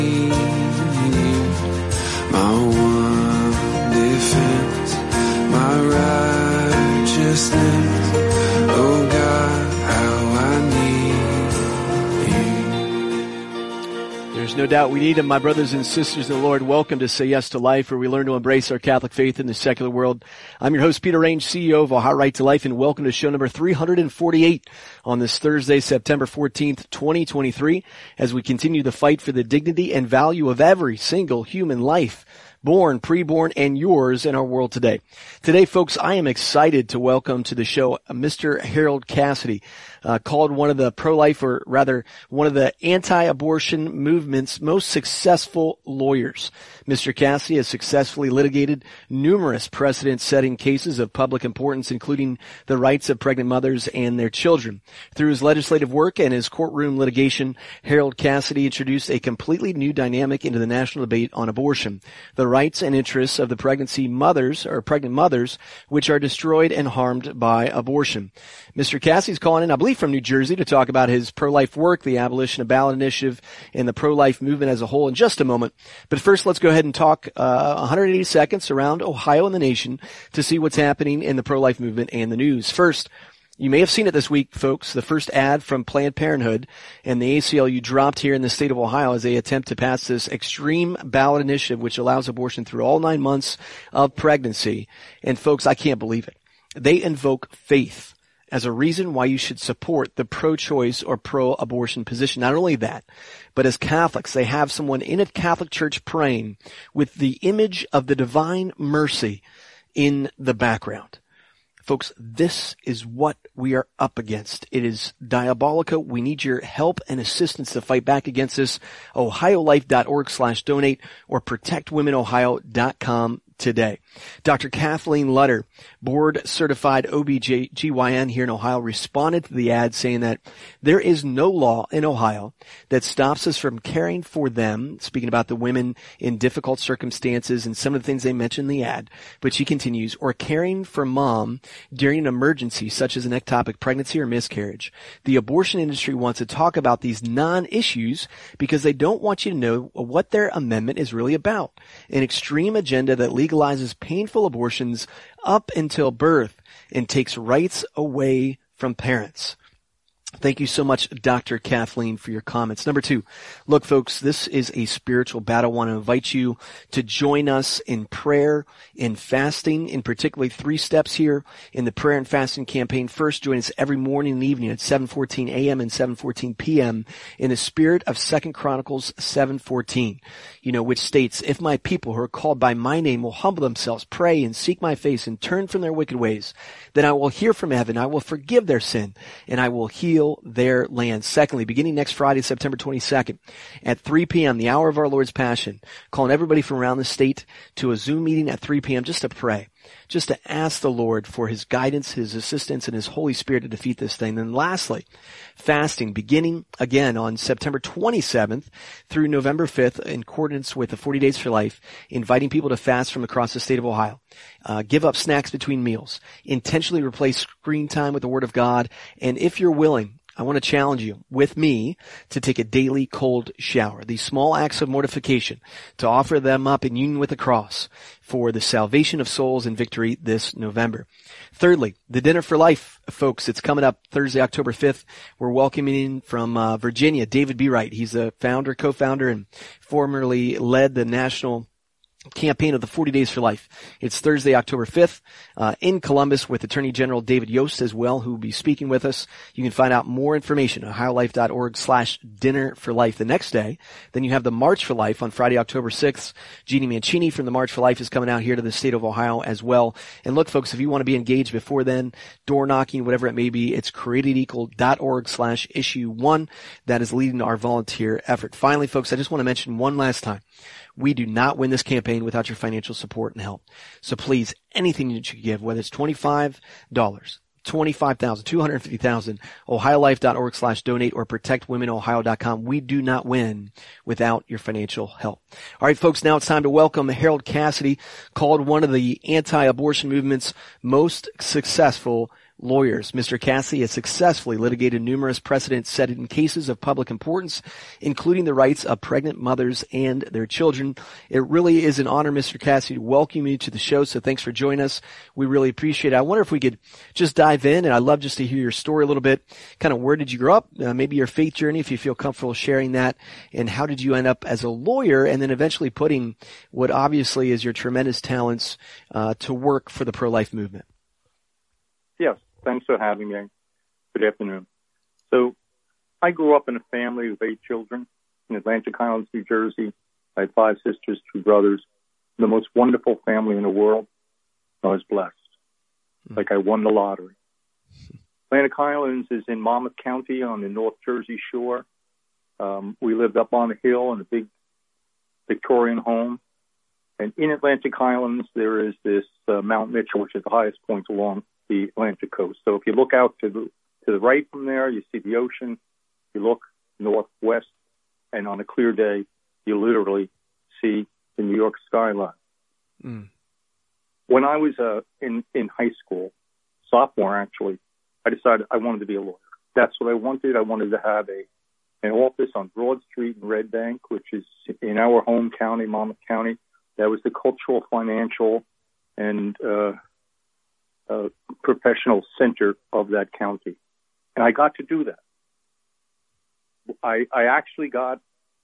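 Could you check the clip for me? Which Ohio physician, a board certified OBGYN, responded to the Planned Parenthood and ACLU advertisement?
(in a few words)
Dr. Kathleen Lutter.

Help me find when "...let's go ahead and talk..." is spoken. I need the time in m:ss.
1:16.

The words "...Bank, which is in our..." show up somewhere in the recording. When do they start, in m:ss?
6:13.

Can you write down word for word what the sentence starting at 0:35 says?
Today, folks, I am excited to welcome to the show uh, Mr.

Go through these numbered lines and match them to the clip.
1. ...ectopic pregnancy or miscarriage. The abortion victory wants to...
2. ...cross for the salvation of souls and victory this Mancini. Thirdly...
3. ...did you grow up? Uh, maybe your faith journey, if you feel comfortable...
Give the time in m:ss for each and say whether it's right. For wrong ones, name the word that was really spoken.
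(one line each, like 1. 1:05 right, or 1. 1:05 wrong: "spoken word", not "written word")
1. 2:23 wrong: "industry", not "victory"
2. 3:47 wrong: "November", not "Mancini"
3. 5:10 right.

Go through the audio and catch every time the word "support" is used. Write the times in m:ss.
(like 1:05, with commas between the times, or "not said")
1:39, 4:32.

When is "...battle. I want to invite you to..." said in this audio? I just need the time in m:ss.
2:45.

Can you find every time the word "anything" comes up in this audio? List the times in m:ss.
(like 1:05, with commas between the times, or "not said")
4:34.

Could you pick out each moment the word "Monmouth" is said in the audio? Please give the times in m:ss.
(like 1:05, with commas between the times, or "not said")
5:39, 6:15.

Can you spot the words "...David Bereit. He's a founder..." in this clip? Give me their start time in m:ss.
3:57.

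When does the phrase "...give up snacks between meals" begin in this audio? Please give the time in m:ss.
3:34.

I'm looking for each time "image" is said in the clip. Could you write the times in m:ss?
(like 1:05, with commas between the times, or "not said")
1:47.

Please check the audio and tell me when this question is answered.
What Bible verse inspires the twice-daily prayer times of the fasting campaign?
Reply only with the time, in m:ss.
2:58.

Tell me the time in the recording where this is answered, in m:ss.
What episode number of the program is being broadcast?
0:23.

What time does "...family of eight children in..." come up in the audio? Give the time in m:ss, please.
5:26.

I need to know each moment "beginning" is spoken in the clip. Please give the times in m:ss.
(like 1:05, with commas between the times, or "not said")
3:11, 3:26.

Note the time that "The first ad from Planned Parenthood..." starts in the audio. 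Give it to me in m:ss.
1:24.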